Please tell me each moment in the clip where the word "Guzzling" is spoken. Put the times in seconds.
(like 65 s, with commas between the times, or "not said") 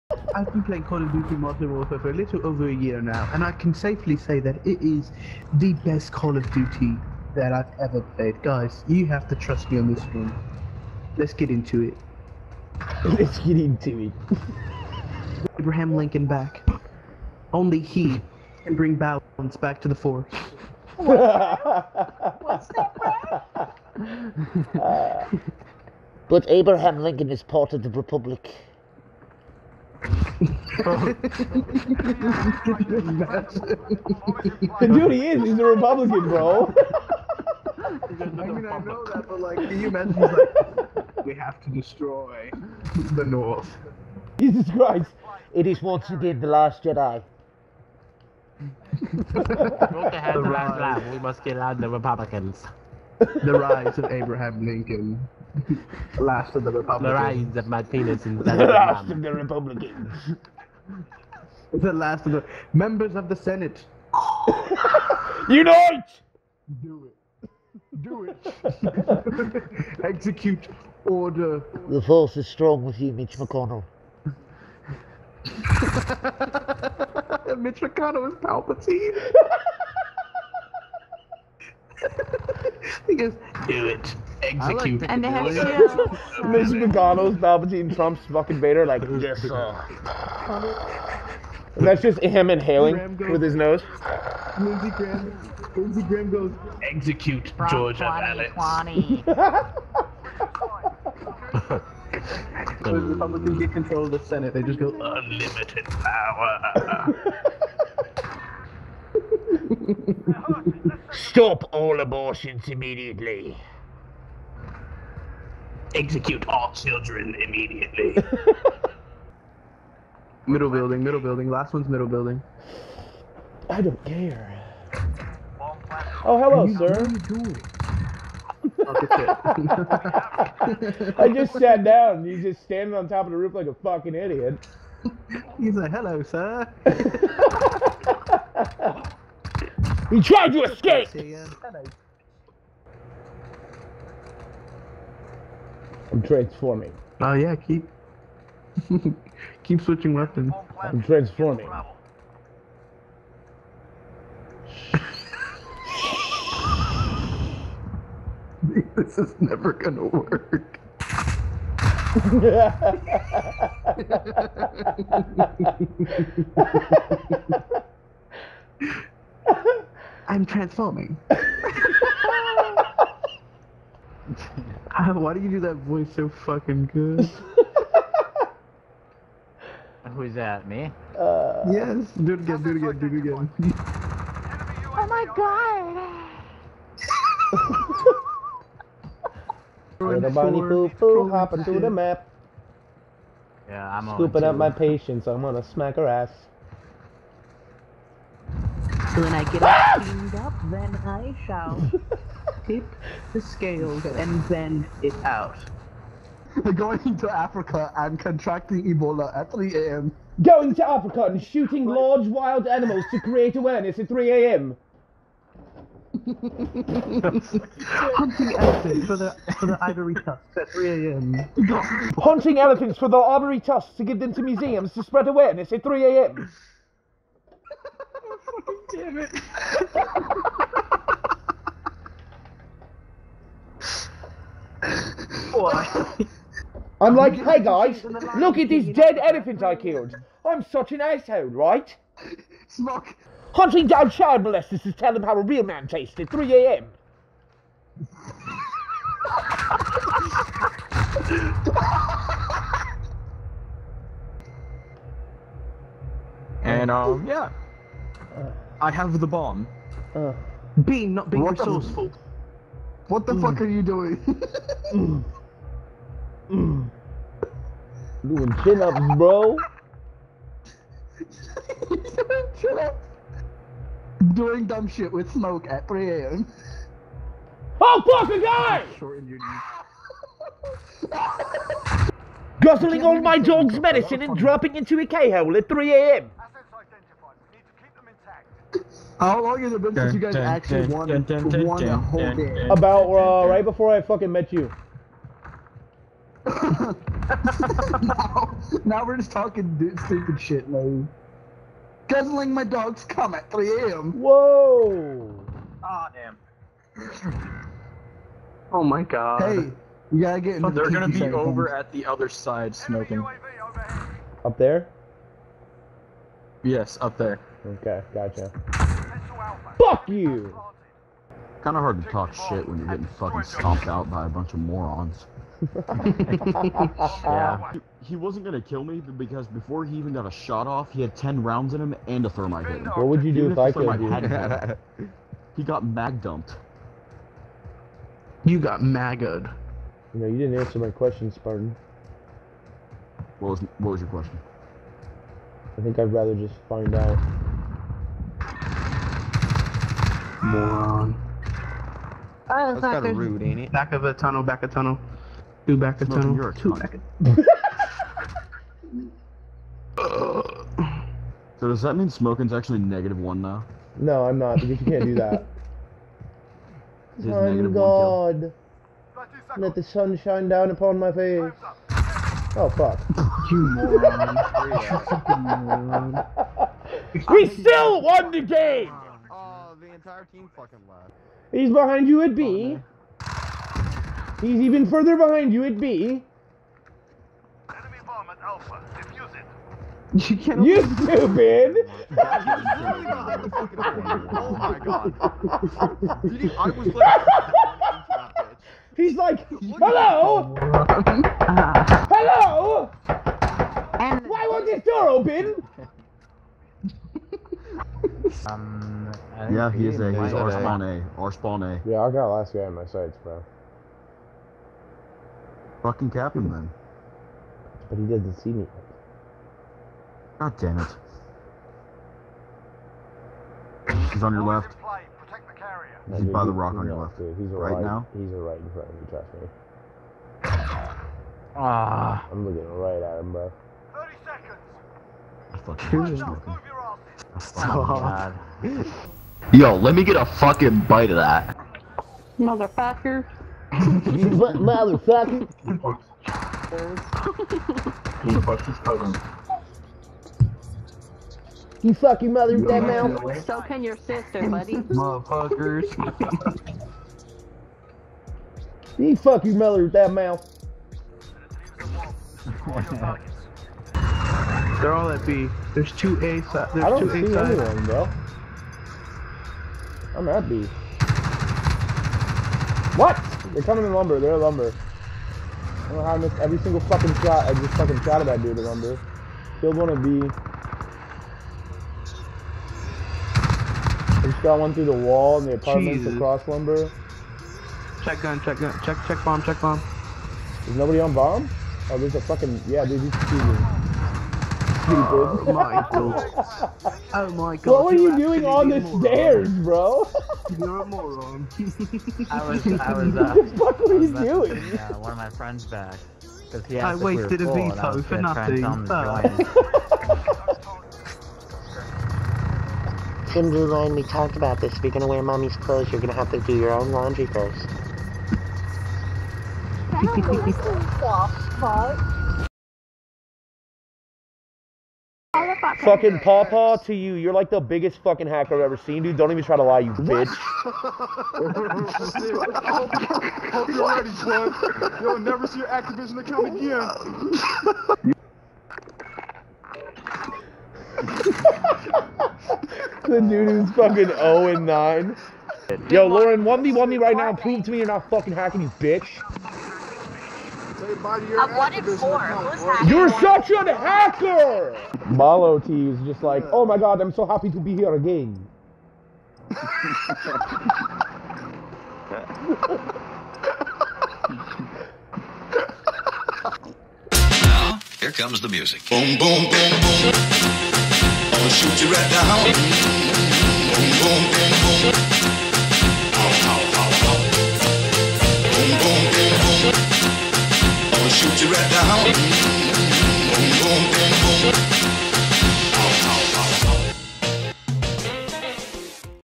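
282 s, 302 s.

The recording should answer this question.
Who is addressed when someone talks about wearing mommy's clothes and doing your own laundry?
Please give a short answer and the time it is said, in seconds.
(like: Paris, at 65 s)
Thin Blue Line, at 513 s.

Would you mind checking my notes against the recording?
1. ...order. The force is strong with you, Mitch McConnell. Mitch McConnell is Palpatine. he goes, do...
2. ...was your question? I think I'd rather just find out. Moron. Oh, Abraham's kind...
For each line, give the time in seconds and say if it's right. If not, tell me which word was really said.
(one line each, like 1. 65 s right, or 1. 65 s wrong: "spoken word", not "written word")
1. 71 s right
2. 343 s wrong: "That", not "Abraham".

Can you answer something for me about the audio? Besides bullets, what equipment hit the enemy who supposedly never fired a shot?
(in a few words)
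thermite.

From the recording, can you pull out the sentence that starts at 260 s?
Uh, being not being what resourceful.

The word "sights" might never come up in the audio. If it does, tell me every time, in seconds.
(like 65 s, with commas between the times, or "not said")
412 s.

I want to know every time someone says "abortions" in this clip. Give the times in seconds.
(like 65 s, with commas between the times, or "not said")
112 s.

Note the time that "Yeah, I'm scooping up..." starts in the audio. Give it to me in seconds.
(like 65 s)
193 s.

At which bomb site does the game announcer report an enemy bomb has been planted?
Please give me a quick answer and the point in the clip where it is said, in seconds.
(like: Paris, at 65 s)
Alpha, at 388 s.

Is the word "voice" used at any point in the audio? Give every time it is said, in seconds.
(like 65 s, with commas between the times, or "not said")
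175 s.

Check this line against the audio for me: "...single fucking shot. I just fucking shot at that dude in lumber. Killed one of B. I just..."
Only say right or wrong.
right.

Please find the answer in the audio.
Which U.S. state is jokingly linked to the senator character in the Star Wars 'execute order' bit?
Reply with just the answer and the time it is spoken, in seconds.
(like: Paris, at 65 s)
Georgia, at 97 s.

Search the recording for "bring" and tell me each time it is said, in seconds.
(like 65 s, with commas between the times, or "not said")
18 s.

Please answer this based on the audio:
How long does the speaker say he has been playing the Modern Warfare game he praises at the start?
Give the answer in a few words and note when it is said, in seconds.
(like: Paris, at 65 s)
a little over a year, at 2 s.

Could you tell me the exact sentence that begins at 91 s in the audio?
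And that's just him inhaling goes, with his nose.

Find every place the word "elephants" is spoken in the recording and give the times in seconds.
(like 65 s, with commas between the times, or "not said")
218 s, 222 s, 239 s.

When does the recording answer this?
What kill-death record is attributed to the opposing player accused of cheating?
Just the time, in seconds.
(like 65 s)
544 s.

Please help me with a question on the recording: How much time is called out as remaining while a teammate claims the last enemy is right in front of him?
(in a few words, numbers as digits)
30 seconds.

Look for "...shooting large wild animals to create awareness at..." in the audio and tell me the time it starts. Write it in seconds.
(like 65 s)
211 s.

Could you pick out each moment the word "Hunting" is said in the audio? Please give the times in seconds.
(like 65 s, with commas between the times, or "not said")
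217 s, 222 s, 243 s.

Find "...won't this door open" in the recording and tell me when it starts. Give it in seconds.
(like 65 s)
404 s.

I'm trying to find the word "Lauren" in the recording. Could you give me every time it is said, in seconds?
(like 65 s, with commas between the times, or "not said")
546 s.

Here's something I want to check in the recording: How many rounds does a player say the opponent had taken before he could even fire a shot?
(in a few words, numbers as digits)
10.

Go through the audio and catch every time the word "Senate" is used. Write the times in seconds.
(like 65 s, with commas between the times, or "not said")
63 s, 104 s.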